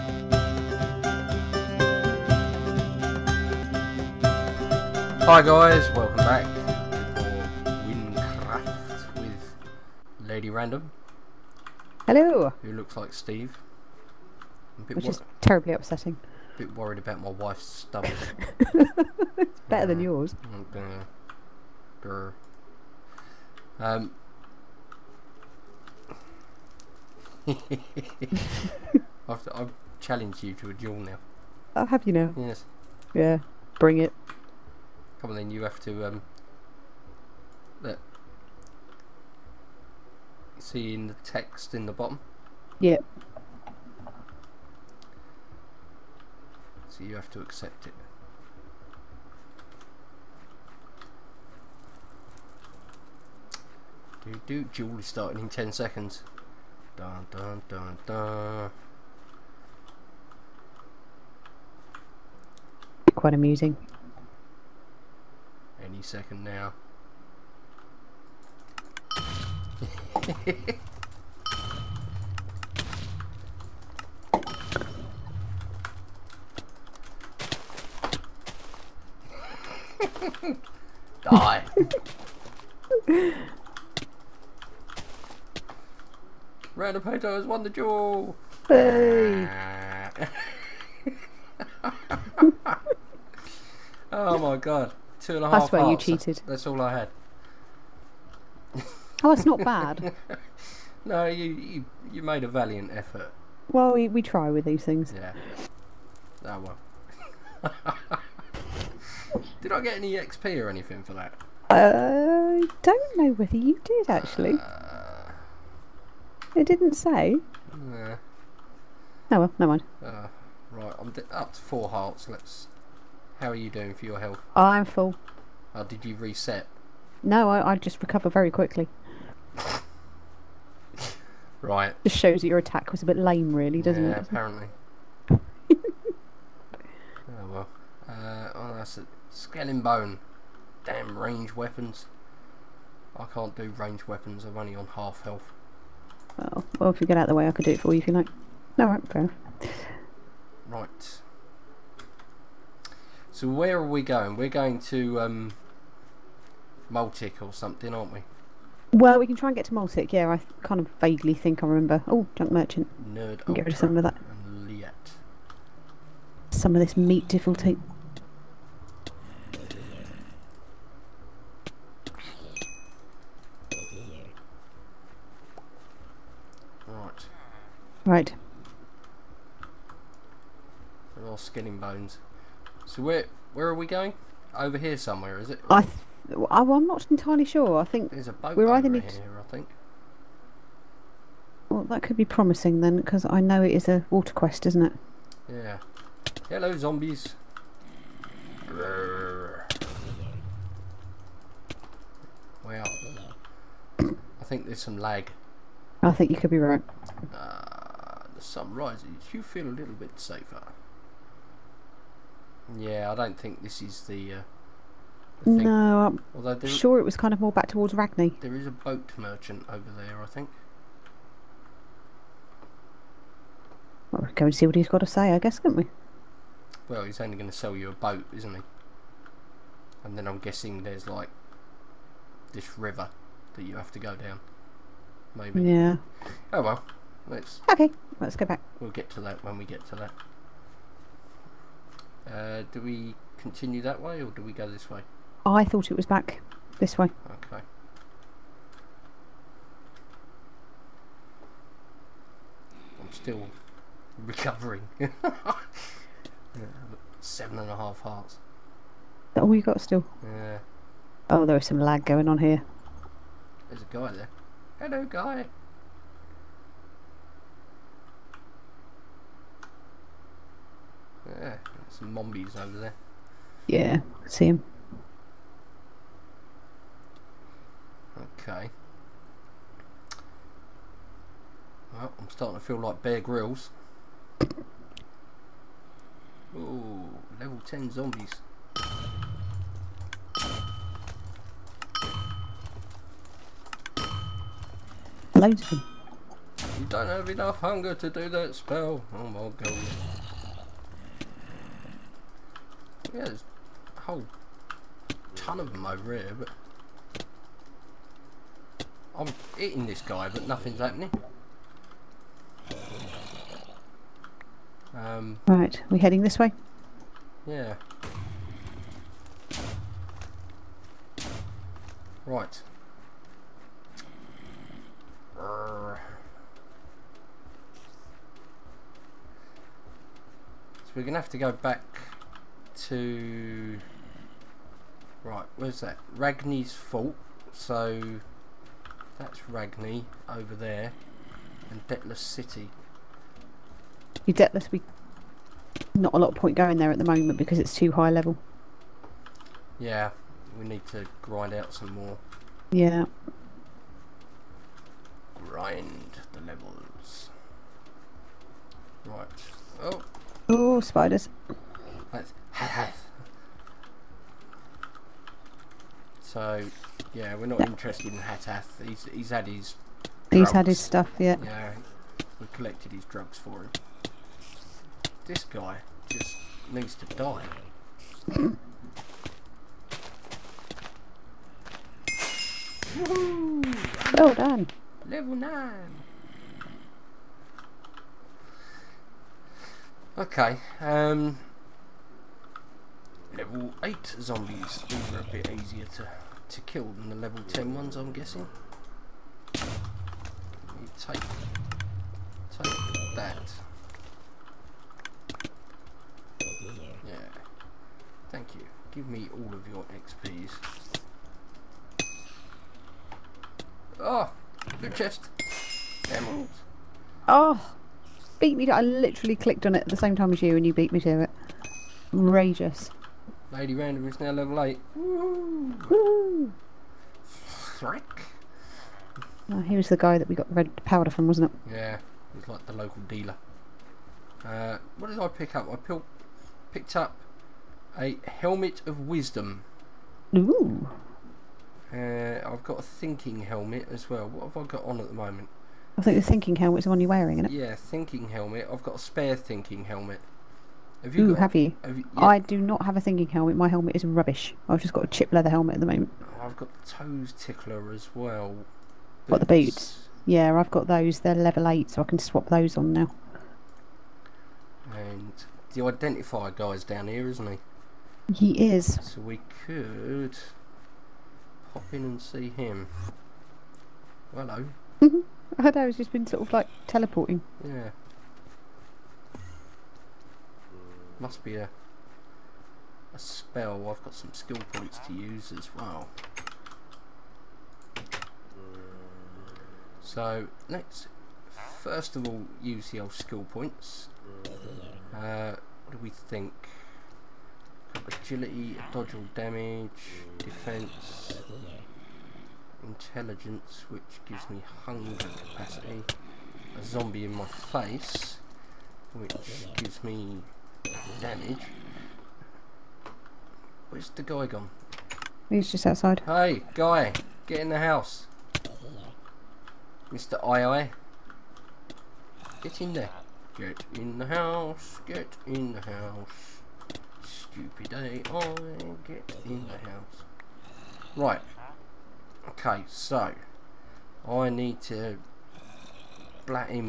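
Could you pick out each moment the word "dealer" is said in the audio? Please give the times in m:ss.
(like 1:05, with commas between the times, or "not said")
7:13.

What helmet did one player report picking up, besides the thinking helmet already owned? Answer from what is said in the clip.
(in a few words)
Helmet of wisdom.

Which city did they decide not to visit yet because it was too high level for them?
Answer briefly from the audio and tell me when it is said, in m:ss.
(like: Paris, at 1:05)
Detlas City, at 5:41.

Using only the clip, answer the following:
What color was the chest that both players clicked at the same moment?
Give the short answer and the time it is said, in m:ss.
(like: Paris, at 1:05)
Blue, at 6:54.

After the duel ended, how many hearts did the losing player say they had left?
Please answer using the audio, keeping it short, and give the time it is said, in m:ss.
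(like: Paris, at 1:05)
2 and a half, at 1:35.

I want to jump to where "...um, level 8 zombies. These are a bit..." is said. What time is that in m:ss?
6:30.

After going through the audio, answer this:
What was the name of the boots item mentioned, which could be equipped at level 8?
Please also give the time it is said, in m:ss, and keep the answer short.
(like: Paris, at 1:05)
Toes tickler, at 7:36.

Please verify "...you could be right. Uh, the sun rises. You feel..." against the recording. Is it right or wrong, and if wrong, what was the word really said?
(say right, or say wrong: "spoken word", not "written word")
right.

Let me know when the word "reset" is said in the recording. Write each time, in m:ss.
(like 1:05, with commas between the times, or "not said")
2:06.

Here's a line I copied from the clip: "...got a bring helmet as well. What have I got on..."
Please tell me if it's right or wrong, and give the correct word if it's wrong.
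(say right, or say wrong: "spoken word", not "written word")
wrong: "thinking", not "bring".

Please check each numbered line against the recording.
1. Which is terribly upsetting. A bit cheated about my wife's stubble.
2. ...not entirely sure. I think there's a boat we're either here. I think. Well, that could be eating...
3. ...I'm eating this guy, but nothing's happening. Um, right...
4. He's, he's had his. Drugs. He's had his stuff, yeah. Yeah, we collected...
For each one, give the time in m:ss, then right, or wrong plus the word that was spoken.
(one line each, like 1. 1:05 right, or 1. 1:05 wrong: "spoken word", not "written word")
1. 0:14 wrong: "worried", not "cheated"
2. 3:06 wrong: "promising", not "eating"
3. 5:09 right
4. 6:08 right.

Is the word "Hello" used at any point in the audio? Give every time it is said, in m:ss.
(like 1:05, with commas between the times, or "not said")
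0:12, 3:16, 4:24, 7:54.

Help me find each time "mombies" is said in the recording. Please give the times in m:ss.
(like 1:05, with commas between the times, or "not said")
4:32.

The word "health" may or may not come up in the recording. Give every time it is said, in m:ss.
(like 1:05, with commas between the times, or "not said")
2:04, 2:25.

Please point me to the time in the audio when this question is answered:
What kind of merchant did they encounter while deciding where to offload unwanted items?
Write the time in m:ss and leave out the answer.
2:42.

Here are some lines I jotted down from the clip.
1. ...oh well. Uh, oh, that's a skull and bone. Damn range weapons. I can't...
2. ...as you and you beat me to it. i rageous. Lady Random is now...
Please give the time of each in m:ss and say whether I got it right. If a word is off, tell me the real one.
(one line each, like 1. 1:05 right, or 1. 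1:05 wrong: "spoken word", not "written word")
1. 2:15 right
2. 7:00 right.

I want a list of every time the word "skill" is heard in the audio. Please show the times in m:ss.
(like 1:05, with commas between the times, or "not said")
8:04, 8:13.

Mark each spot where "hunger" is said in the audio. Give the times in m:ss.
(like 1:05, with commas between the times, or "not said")
4:57, 8:24.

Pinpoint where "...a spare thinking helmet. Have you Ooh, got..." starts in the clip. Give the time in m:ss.
7:28.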